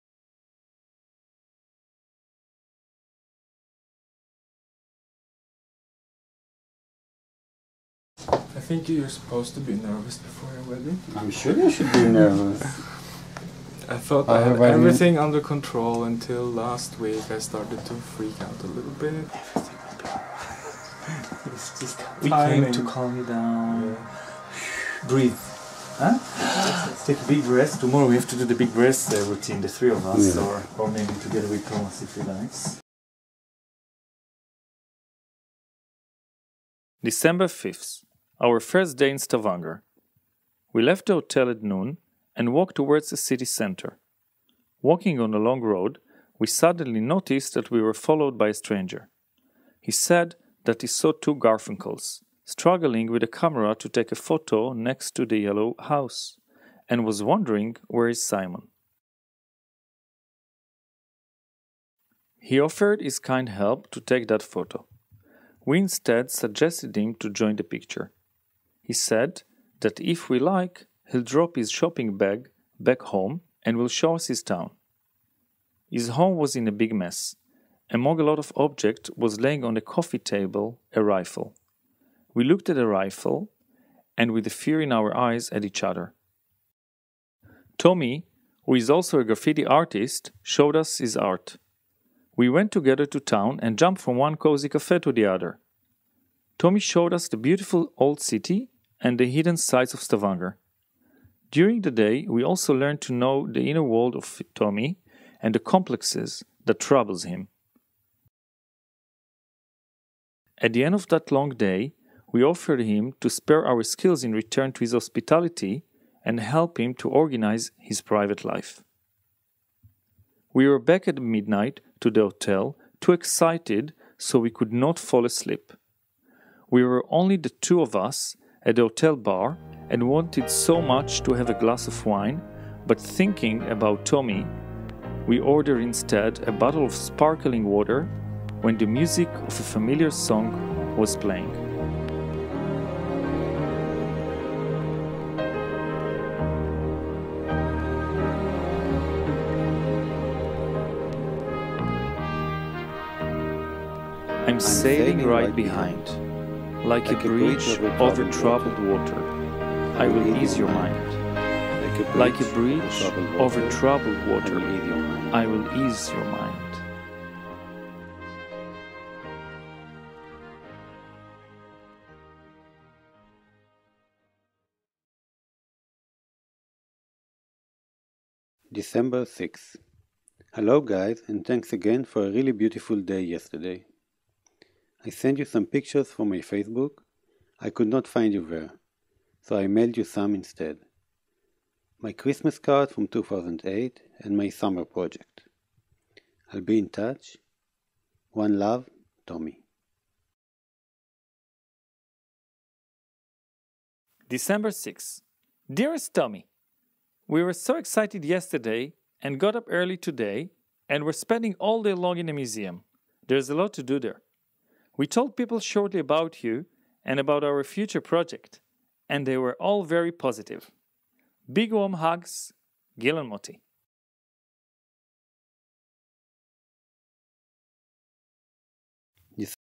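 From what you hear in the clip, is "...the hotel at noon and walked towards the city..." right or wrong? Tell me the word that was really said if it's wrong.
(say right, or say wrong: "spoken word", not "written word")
right.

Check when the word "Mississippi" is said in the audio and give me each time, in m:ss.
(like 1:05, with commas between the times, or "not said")
not said.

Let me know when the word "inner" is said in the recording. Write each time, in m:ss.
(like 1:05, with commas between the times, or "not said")
1:43.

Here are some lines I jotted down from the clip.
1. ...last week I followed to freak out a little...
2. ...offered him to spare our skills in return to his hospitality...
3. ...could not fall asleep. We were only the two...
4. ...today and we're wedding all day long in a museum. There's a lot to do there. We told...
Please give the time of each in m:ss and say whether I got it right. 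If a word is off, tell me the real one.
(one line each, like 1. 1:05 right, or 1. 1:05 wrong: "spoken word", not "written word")
1. 0:16 wrong: "started", not "followed"
2. 1:52 right
3. 2:04 right
4. 3:29 wrong: "spending", not "wedding".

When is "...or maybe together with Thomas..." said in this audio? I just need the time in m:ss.
0:30.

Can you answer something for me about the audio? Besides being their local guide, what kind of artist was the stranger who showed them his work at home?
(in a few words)
Graffiti artist.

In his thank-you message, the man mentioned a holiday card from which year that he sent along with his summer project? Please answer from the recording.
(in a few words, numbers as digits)
2008.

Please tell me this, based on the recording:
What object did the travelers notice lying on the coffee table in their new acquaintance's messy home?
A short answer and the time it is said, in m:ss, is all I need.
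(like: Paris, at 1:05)
A rifle, at 1:20.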